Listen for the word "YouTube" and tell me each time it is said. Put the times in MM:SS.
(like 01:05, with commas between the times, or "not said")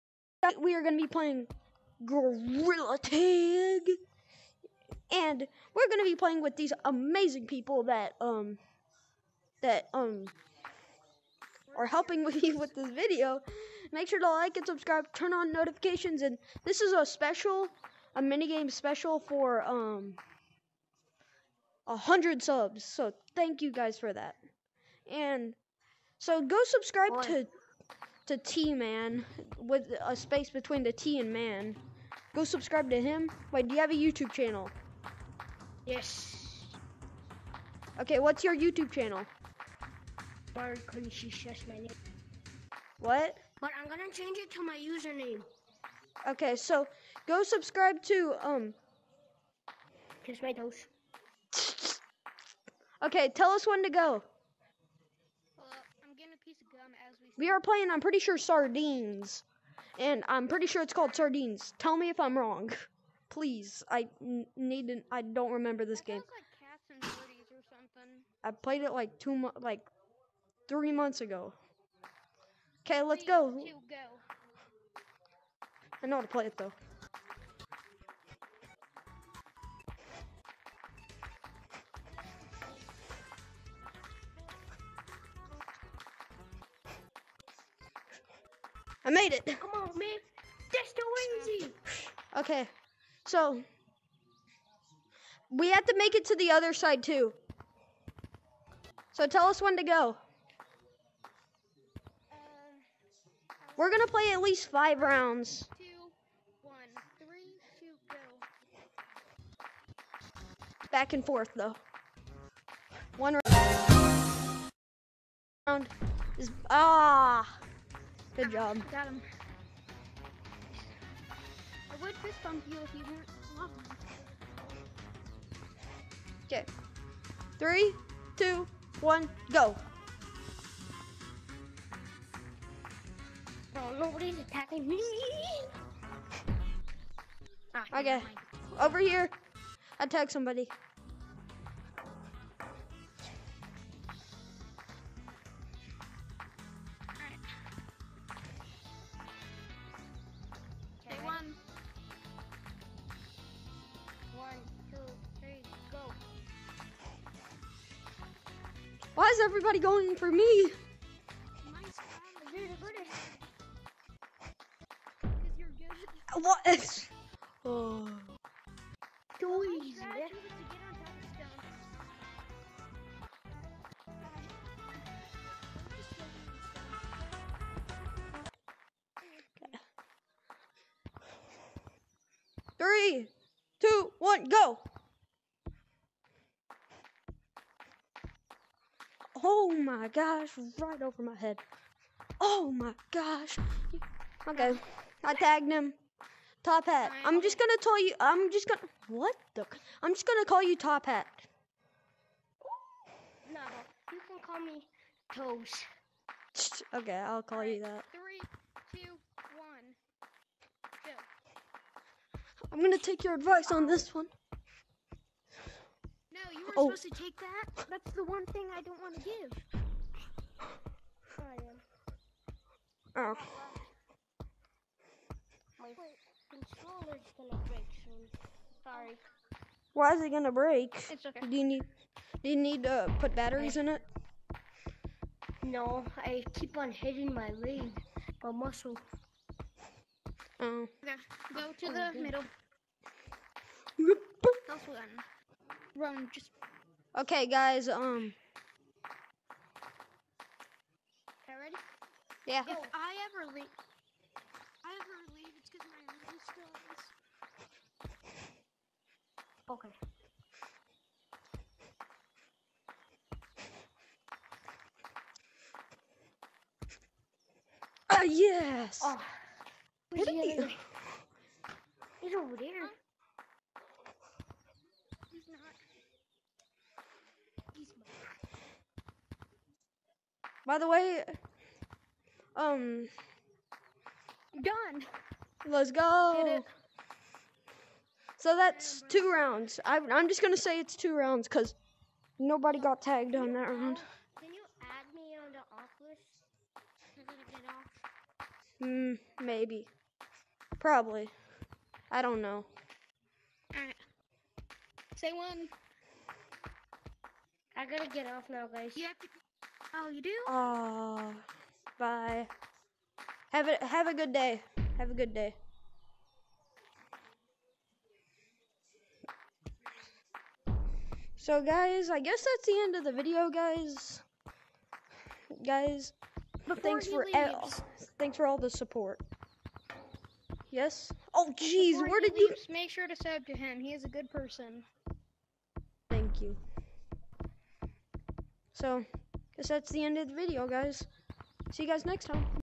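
00:33, 00:38.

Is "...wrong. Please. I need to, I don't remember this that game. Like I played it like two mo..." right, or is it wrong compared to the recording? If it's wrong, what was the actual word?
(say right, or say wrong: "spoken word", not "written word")
right.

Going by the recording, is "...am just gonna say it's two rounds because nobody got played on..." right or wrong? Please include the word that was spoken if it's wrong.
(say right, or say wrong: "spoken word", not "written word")
wrong: "tagged", not "played".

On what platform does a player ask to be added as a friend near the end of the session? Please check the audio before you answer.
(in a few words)
Oculus.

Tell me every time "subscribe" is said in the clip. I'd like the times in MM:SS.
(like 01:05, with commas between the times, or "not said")
00:14, 00:26, 00:32, 00:47.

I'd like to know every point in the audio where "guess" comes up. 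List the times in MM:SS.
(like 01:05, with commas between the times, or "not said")
05:22, 05:39.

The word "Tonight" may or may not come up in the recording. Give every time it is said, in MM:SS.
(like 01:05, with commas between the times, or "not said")
00:00.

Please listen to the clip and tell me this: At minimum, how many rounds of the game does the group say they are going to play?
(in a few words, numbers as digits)
5.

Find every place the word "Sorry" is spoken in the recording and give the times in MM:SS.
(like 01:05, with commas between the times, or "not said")
03:48.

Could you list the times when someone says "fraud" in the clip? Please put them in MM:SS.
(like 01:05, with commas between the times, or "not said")
not said.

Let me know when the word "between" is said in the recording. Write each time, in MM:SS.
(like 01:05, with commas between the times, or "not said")
00:30.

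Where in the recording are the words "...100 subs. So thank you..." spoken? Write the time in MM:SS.
00:21.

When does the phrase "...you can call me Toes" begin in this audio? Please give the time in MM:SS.
03:24.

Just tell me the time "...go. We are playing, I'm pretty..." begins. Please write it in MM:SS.
00:53.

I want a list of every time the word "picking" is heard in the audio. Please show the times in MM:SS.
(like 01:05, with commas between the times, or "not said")
not said.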